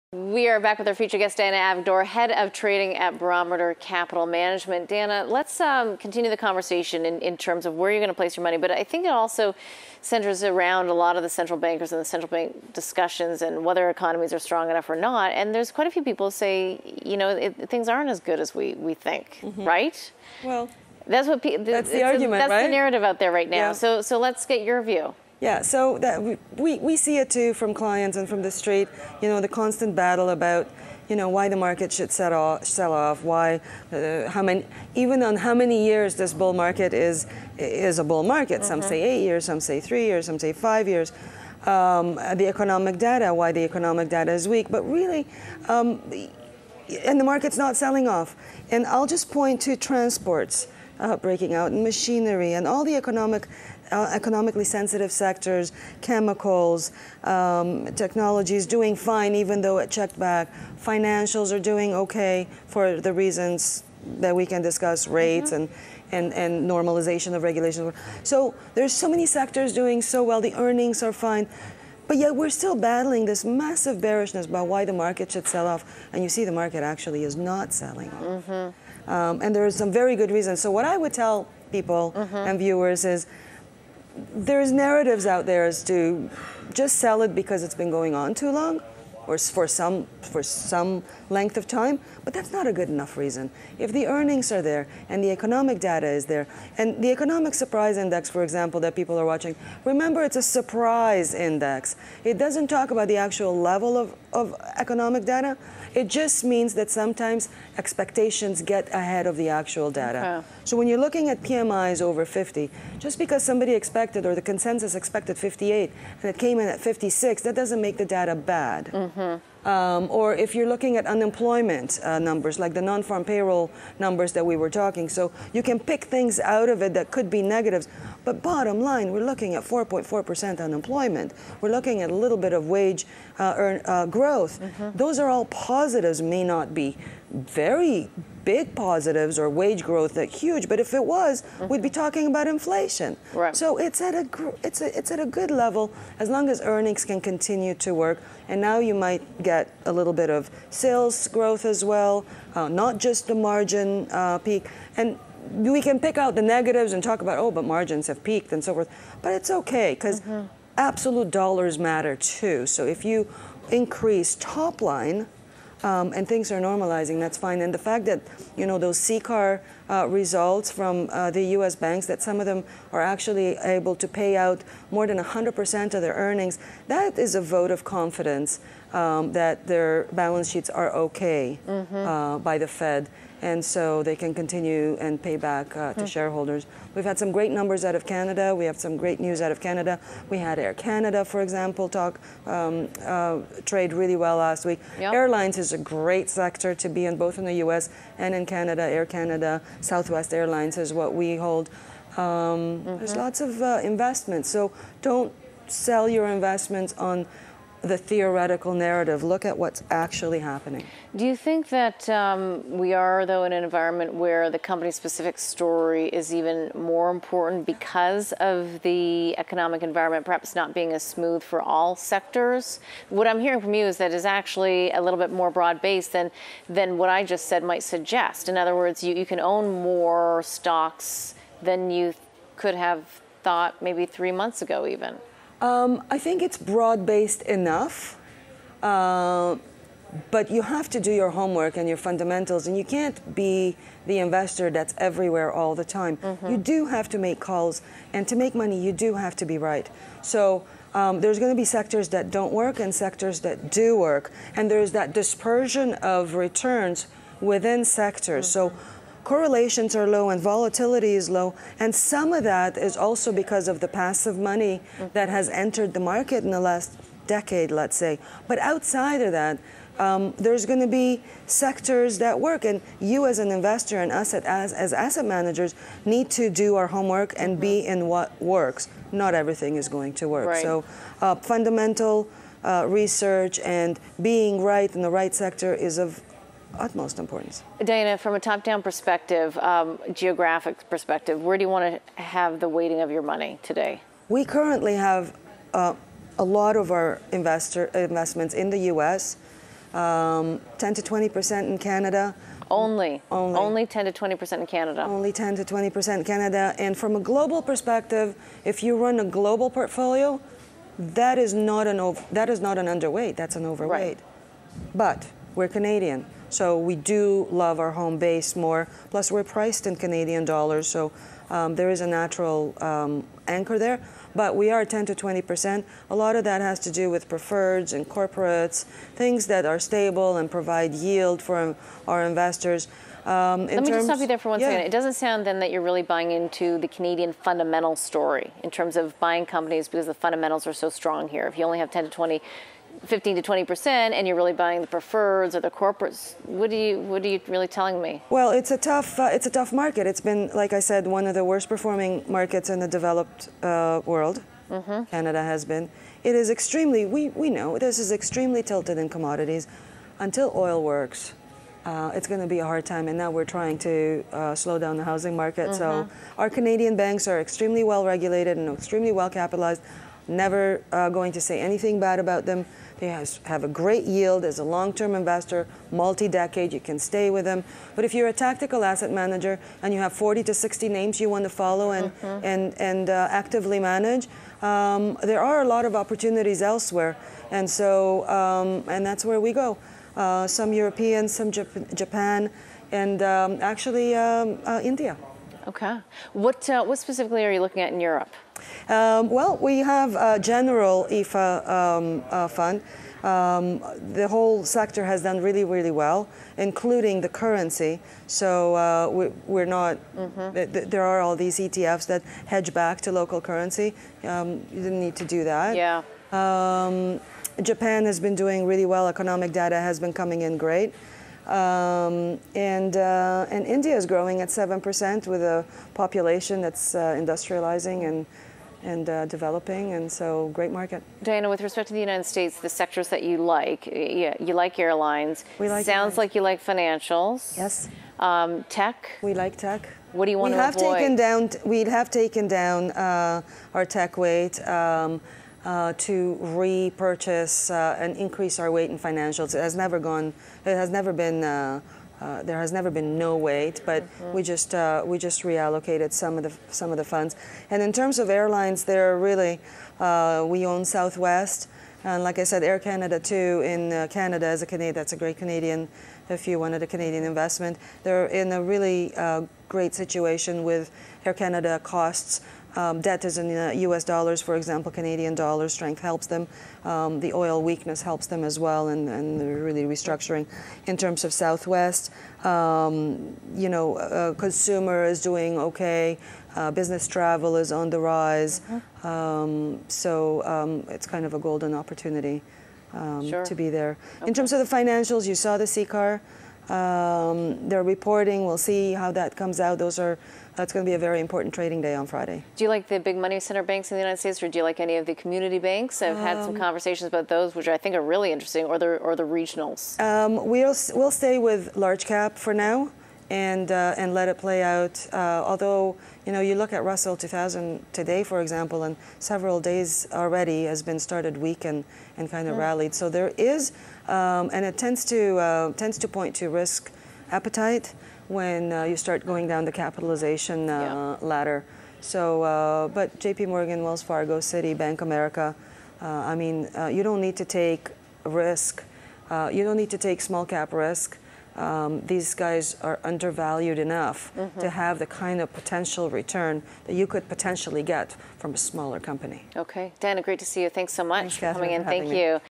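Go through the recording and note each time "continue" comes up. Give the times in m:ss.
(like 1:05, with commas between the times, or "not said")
0:05, 2:27, 3:04.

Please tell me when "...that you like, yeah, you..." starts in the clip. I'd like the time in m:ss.
7:13.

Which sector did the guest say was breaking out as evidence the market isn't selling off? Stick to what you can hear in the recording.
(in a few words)
transports.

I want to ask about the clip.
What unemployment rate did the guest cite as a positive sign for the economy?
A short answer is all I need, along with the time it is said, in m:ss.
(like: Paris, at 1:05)
4.4%, at 2:09.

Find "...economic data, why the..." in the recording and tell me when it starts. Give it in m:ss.
0:42.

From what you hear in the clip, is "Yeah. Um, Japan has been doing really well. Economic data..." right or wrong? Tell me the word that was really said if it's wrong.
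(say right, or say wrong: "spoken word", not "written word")
right.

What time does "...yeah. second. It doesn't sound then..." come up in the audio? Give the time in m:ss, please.
5:34.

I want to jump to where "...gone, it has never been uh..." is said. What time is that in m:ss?
7:29.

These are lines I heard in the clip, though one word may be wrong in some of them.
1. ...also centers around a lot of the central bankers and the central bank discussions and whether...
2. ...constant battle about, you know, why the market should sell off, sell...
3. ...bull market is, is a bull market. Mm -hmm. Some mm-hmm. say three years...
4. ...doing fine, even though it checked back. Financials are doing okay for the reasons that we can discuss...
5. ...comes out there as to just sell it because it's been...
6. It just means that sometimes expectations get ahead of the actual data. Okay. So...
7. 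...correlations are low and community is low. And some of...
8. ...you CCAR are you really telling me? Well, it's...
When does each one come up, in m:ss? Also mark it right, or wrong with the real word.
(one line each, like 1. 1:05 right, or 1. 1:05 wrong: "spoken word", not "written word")
1. 0:09 right
2. 0:29 right
3. 0:36 wrong: "eight", not "three"
4. 0:58 right
5. 1:24 wrong: "narratives", not "comes"
6. 1:45 right
7. 4:19 wrong: "volatility", not "community"
8. 5:46 wrong: "What", not "CCAR".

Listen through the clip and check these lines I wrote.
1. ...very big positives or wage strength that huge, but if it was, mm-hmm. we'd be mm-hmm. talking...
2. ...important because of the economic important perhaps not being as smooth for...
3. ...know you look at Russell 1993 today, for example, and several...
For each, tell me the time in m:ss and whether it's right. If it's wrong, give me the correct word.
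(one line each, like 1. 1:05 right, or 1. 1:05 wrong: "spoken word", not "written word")
1. 2:17 wrong: "growth", not "strength"
2. 3:37 wrong: "environment", not "important"
3. 8:36 wrong: "2000", not "1993".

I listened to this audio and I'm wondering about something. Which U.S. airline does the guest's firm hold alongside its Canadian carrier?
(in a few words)
Southwest Airlines.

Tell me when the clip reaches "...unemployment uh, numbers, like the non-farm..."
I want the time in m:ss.
2:01.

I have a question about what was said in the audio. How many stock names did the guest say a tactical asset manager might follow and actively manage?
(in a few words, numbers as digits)
40 to 60.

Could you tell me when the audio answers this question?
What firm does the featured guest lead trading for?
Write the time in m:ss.
0:03.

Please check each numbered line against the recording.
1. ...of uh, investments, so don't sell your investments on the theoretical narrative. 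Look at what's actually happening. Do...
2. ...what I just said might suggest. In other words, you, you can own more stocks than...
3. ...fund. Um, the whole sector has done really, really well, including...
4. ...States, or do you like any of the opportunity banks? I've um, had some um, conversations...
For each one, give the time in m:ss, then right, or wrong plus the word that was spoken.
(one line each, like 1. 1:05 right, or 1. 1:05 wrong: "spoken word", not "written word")
1. 3:23 right
2. 3:46 right
3. 6:42 right
4. 8:24 wrong: "community", not "opportunity".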